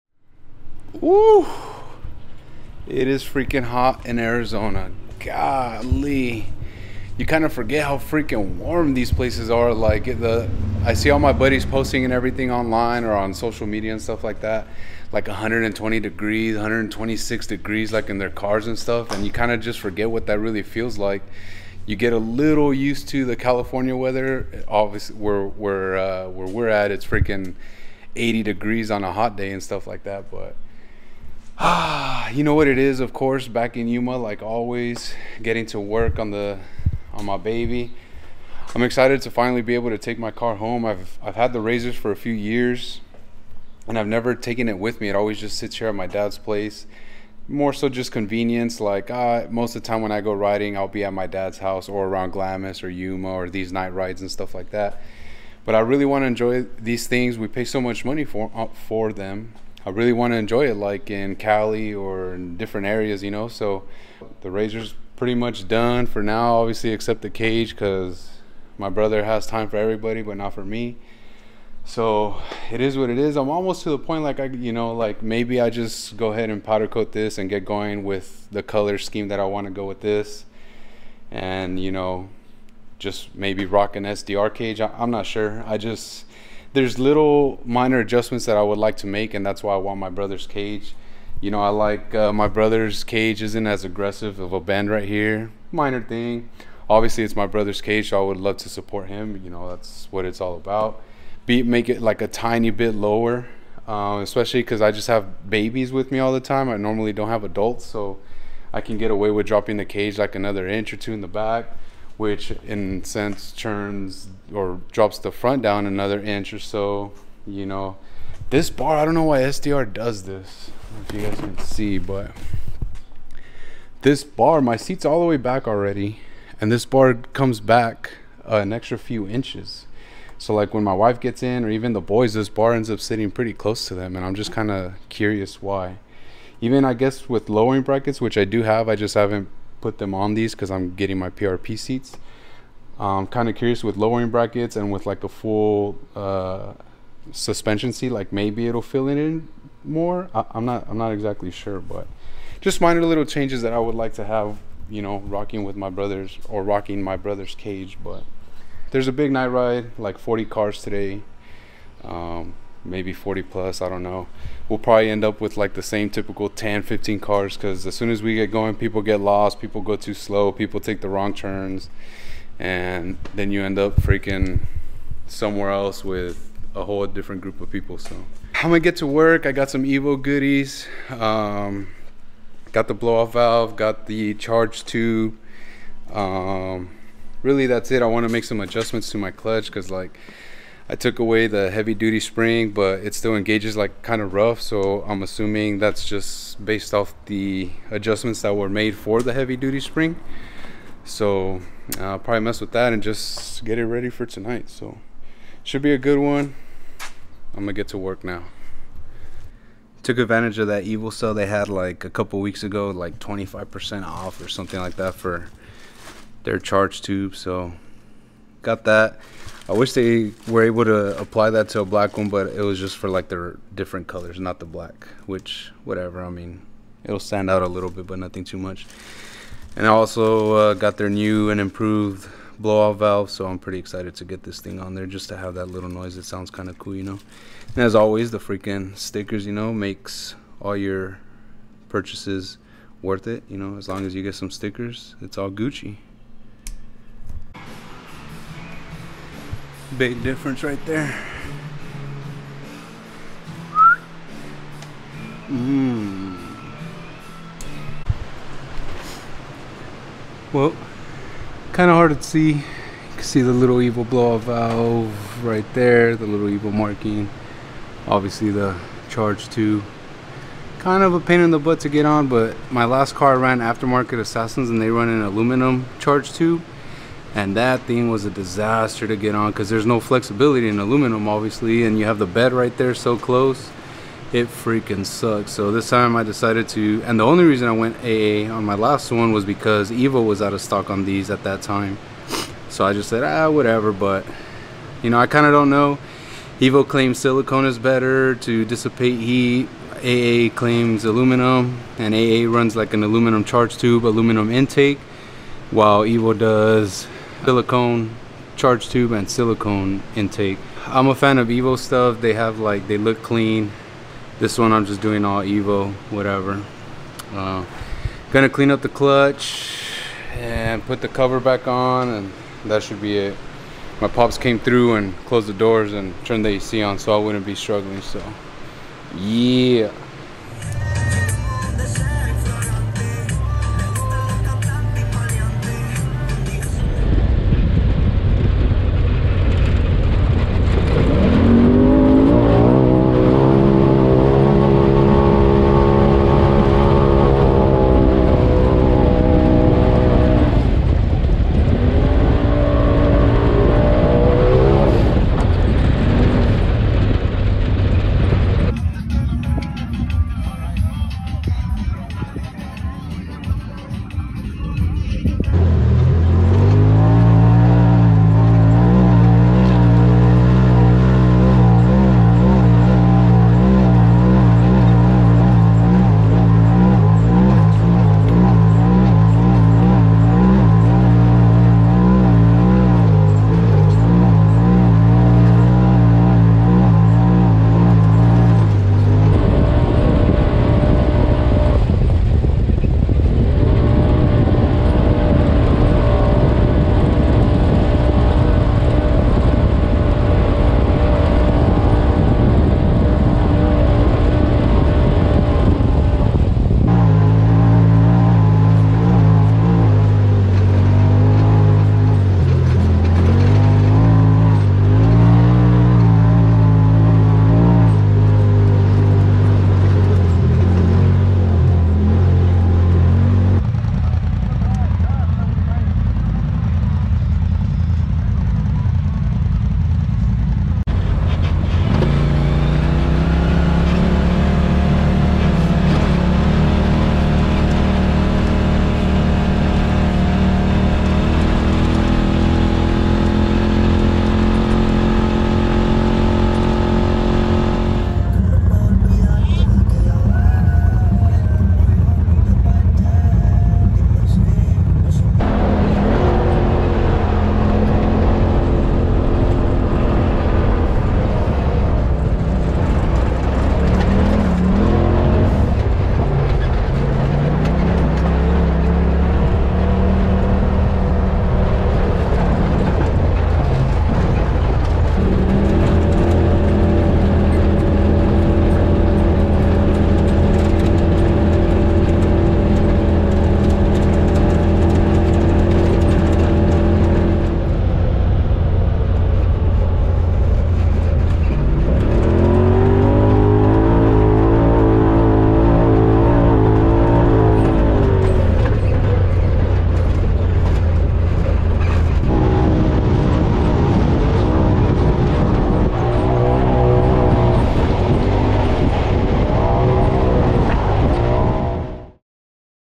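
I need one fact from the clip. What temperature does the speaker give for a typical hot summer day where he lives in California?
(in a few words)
80 degrees.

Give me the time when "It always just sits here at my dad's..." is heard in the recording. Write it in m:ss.
0:45.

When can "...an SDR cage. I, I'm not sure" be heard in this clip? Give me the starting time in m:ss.
1:23.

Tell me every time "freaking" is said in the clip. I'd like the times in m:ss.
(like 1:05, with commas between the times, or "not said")
0:03, 0:07, 0:27, 2:53, 3:58, 4:44.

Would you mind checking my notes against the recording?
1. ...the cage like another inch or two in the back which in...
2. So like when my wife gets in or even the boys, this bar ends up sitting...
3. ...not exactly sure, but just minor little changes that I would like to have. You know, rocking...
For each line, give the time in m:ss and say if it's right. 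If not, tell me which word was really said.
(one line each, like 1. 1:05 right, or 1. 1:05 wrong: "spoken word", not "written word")
1. 1:49 right
2. 2:10 right
3. 2:30 right.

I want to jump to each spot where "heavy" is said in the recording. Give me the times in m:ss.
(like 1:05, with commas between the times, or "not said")
3:11, 3:19.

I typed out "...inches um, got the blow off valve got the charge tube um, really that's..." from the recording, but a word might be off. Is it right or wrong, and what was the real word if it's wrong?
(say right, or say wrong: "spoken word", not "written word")
wrong: "goodies", not "inches".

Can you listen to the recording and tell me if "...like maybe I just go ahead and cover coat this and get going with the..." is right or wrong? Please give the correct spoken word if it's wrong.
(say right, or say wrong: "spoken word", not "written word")
wrong: "powder", not "cover".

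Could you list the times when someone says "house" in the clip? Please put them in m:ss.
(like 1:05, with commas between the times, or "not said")
0:51.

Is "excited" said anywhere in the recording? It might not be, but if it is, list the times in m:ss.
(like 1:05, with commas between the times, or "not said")
0:38, 3:53.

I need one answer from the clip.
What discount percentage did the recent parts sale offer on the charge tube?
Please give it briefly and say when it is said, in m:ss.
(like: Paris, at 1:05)
25%, at 3:33.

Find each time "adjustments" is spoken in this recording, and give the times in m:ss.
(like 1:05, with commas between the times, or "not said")
1:27, 3:08, 3:17.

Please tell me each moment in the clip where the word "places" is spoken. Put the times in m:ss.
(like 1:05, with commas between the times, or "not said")
0:09, 0:46.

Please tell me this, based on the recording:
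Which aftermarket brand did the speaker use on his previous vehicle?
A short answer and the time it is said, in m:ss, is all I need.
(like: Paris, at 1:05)
Assassins, at 4:34.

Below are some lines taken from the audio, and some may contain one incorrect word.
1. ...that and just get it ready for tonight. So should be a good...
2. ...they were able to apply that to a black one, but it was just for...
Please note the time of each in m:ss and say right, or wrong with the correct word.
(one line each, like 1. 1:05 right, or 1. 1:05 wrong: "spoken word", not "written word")
1. 3:22 right
2. 3:39 right.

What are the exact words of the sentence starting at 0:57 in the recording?
We pay so much money for, uh, for them.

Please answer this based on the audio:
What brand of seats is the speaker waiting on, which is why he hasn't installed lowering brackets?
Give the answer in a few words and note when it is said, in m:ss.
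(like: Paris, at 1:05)
PRP, at 2:21.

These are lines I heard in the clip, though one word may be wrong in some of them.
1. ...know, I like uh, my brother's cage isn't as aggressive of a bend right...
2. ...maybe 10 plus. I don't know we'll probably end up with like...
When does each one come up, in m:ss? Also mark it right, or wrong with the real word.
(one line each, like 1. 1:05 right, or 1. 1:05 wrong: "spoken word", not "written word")
1. 1:31 right
2. 2:42 wrong: "40", not "10".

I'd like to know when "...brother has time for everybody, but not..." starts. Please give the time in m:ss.
1:08.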